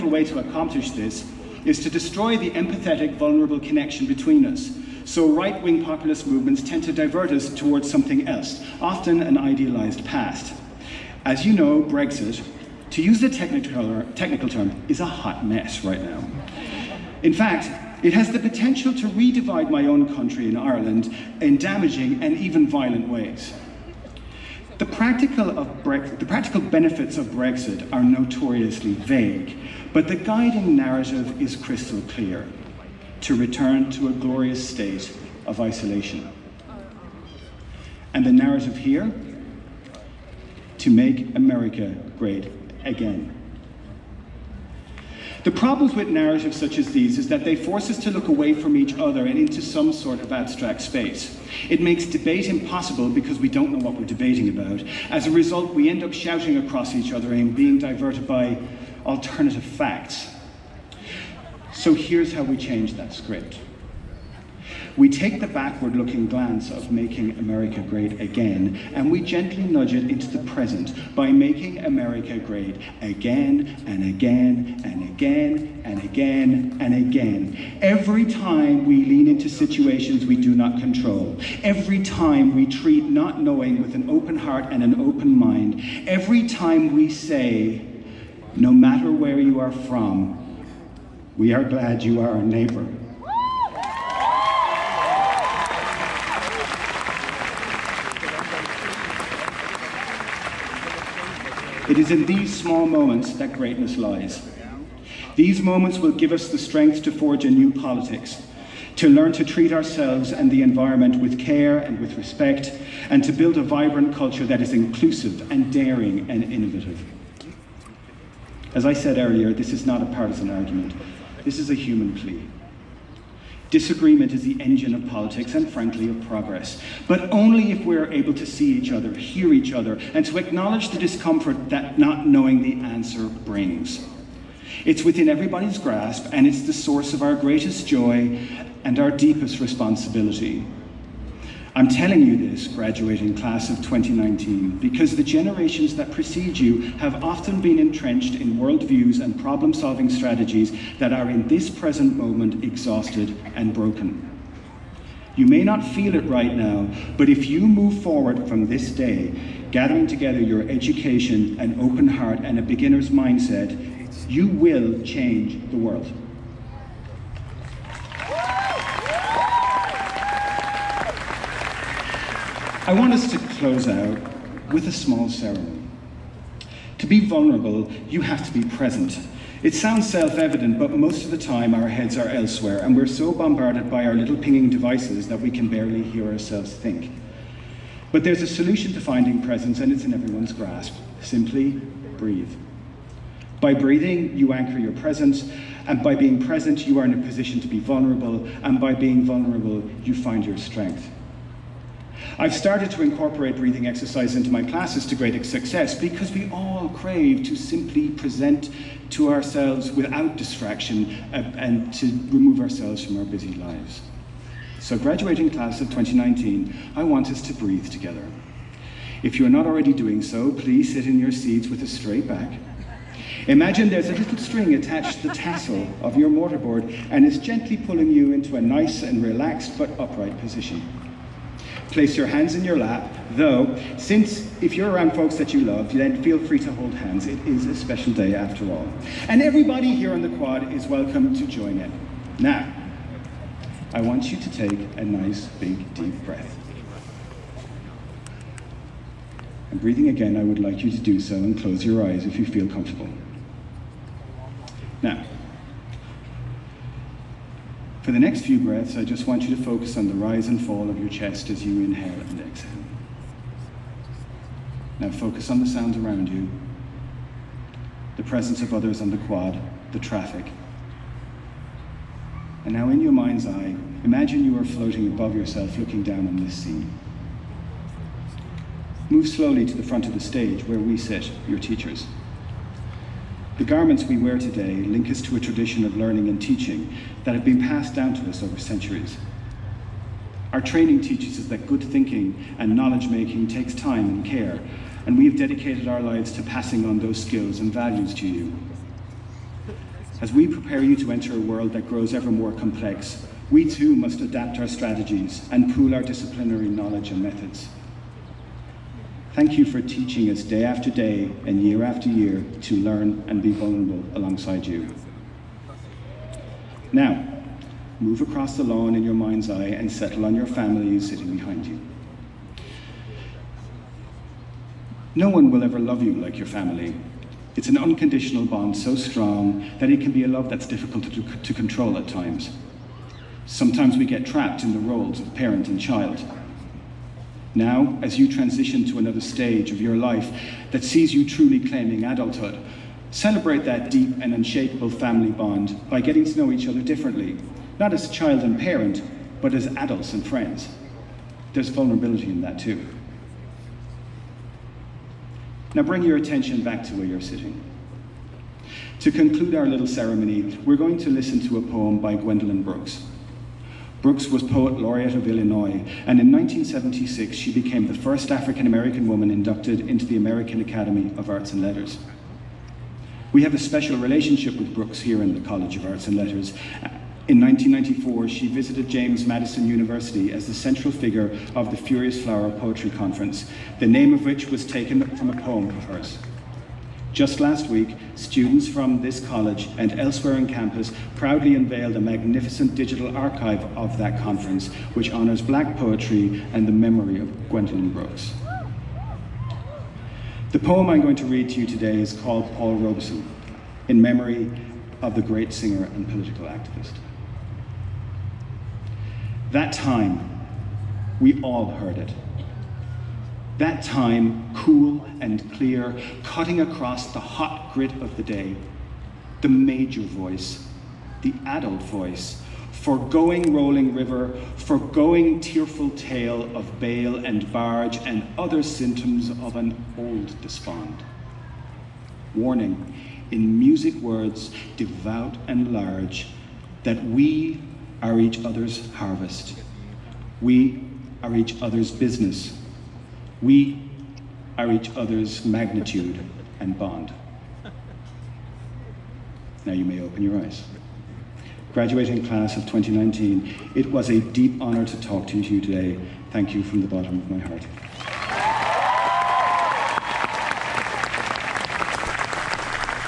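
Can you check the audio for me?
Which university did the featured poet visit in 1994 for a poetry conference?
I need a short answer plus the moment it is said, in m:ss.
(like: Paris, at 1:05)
James Madison University, at 6:18.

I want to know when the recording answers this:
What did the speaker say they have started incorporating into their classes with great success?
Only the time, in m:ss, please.
3:23.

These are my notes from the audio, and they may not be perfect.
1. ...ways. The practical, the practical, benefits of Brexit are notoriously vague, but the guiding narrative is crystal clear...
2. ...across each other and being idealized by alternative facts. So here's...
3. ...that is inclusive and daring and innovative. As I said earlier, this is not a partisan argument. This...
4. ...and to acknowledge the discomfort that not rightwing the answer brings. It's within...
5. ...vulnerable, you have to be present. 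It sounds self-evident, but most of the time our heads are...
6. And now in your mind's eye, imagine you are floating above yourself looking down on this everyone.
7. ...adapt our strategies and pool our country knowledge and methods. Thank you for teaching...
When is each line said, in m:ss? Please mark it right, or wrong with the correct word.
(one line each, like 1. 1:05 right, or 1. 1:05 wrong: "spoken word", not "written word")
1. 0:23 right
2. 0:56 wrong: "diverted", not "idealized"
3. 1:54 right
4. 2:10 wrong: "knowing", not "rightwing"
5. 2:57 right
6. 4:32 wrong: "scene", not "everyone"
7. 5:04 wrong: "disciplinary", not "country".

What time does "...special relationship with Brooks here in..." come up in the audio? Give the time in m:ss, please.
6:13.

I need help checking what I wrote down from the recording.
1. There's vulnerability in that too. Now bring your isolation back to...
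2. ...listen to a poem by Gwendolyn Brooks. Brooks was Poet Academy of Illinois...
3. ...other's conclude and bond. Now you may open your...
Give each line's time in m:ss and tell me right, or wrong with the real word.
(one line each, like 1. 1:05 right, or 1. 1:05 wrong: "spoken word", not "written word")
1. 5:51 wrong: "attention", not "isolation"
2. 6:01 wrong: "Laureate", not "Academy"
3. 7:24 wrong: "magnitude", not "conclude".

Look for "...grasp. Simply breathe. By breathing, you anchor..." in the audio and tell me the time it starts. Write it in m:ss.
3:10.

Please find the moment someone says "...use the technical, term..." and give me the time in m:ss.
0:13.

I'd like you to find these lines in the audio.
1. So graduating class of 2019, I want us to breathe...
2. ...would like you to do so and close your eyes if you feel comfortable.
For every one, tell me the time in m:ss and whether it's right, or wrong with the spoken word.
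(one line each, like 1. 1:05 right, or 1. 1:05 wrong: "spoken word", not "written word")
1. 3:34 right
2. 4:10 right.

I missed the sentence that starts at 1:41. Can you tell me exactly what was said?
It is in these small moments that greatness lies.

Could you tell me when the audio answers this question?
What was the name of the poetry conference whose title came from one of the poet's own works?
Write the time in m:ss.
6:21.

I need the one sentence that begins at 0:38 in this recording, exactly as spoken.
And the narrative here, to make America great again.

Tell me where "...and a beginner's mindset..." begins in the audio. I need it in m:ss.
2:42.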